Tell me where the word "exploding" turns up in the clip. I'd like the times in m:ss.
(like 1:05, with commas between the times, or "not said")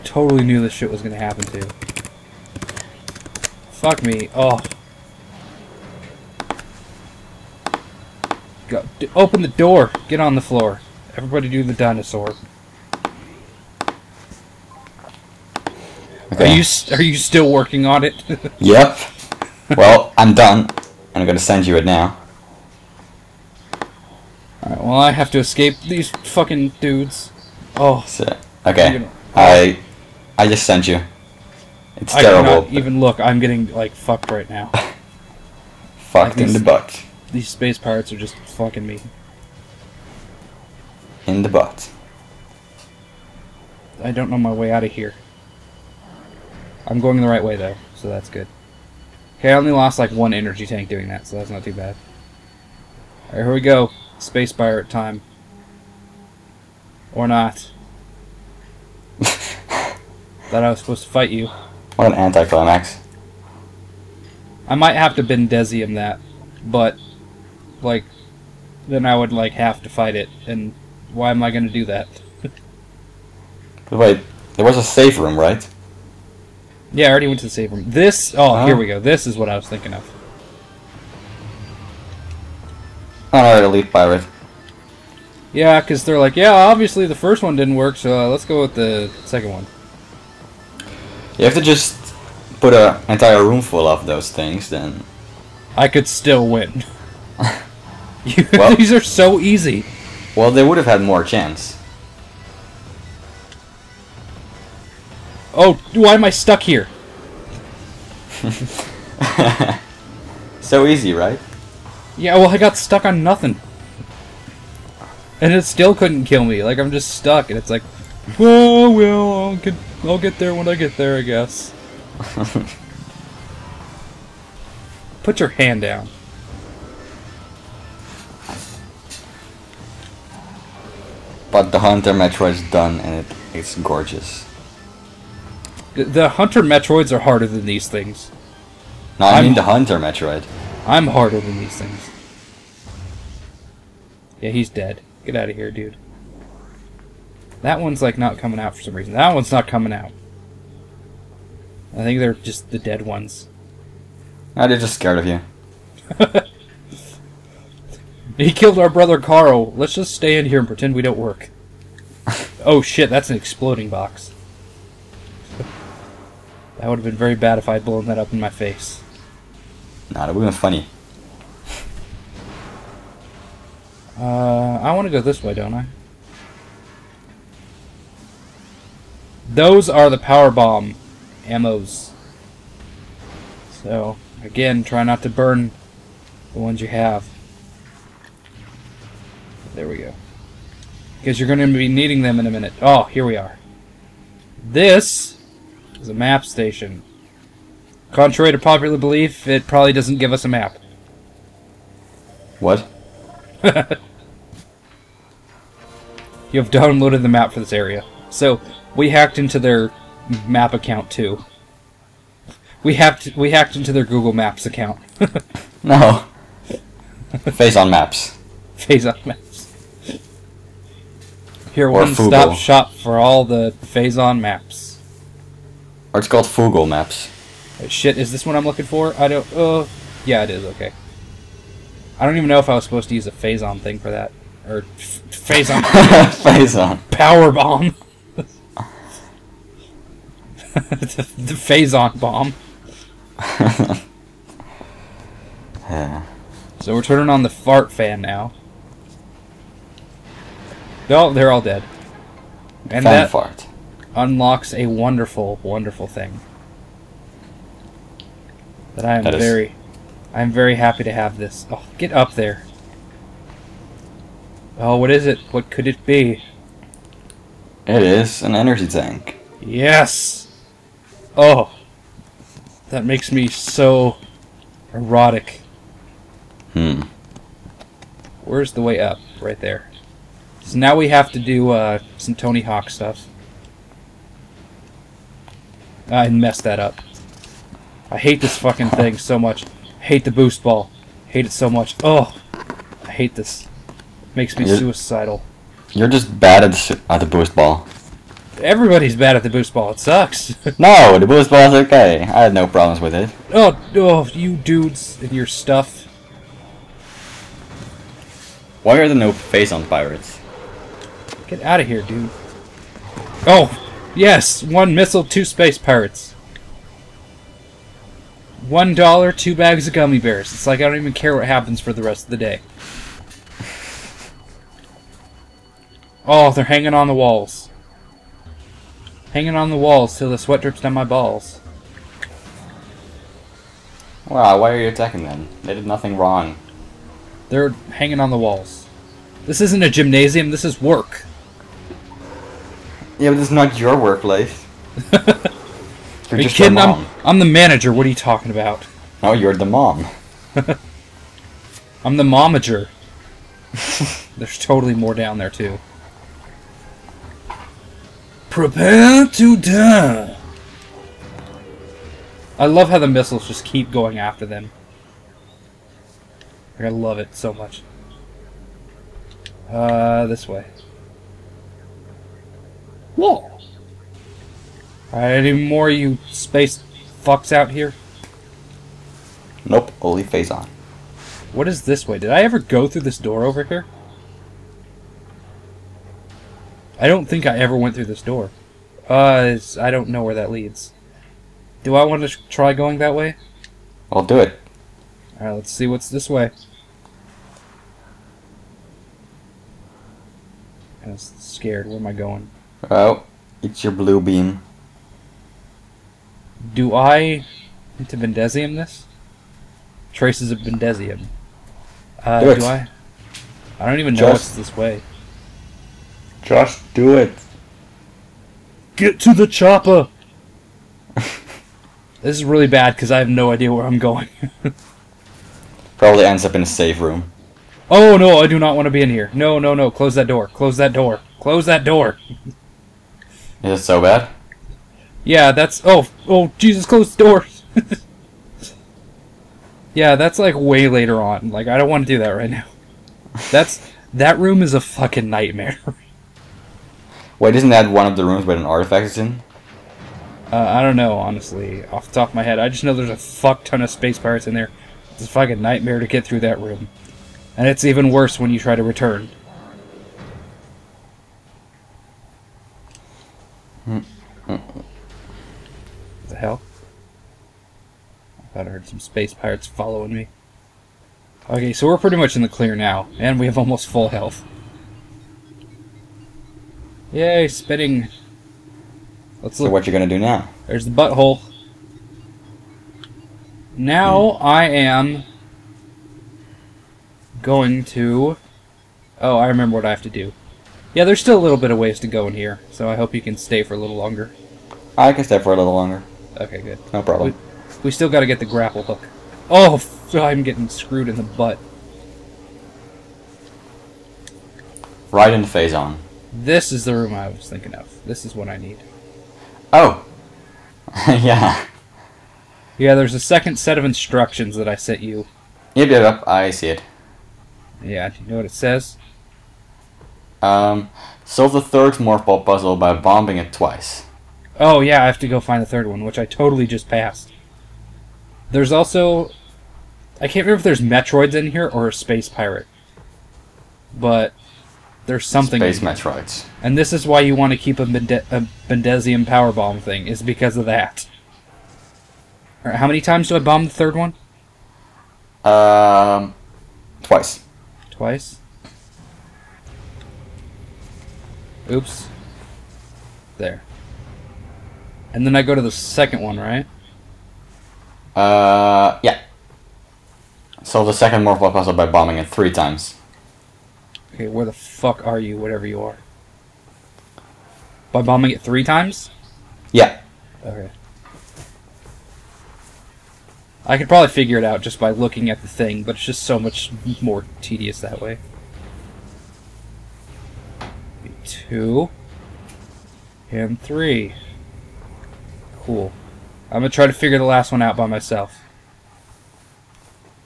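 2:43.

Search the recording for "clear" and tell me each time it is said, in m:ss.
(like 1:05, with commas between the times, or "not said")
7:52.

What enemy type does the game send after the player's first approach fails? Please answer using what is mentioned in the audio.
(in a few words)
Elite Pirate.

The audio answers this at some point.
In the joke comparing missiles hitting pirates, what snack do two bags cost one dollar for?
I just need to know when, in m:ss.
5:19.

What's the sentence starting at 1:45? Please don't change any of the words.
Oh, why am I stuck here?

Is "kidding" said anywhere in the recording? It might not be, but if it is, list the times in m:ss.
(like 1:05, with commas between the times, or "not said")
5:46.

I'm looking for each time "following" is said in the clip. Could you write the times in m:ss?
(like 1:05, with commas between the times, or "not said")
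7:49.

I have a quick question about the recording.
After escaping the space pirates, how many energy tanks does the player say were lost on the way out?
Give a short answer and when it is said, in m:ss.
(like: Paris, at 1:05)
1, at 0:50.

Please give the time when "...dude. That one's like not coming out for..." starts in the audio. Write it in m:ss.
2:25.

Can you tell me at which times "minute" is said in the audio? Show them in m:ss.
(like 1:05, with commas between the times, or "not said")
3:12.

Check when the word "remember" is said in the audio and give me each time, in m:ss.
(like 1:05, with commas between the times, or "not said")
8:09, 8:50.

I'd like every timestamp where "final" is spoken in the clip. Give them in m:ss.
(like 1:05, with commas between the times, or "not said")
not said.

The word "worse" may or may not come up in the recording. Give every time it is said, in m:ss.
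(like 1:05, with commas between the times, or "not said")
7:38.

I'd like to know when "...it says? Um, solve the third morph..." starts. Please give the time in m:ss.
8:38.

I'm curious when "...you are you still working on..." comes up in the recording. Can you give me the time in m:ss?
0:16.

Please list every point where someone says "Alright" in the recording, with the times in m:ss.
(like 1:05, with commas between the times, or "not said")
0:24, 0:53, 1:23, 6:35, 9:02.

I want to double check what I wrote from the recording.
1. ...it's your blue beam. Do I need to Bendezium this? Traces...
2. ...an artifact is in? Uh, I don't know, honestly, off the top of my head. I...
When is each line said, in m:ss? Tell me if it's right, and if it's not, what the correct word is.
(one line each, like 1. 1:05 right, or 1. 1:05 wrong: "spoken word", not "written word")
1. 6:43 right
2. 7:28 right.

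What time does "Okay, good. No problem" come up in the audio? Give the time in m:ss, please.
8:16.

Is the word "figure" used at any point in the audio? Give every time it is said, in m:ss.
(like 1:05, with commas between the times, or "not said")
9:34, 9:46.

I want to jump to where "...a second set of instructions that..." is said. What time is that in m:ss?
8:33.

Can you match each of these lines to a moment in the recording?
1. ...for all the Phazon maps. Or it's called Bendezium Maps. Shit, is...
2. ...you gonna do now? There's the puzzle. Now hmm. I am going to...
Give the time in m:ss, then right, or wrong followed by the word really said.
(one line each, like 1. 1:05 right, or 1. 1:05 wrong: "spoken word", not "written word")
1. 3:42 wrong: "Fugle", not "Bendezium"
2. 7:59 wrong: "butthole", not "puzzle".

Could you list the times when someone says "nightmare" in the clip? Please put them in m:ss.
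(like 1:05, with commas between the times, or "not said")
7:25, 7:35.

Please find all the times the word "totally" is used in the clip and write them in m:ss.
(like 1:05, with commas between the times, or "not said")
5:54, 8:46.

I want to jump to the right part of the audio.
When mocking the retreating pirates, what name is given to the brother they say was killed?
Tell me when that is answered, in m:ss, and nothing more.
2:39.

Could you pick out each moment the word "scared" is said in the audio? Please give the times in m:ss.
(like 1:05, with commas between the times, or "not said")
2:34, 6:41.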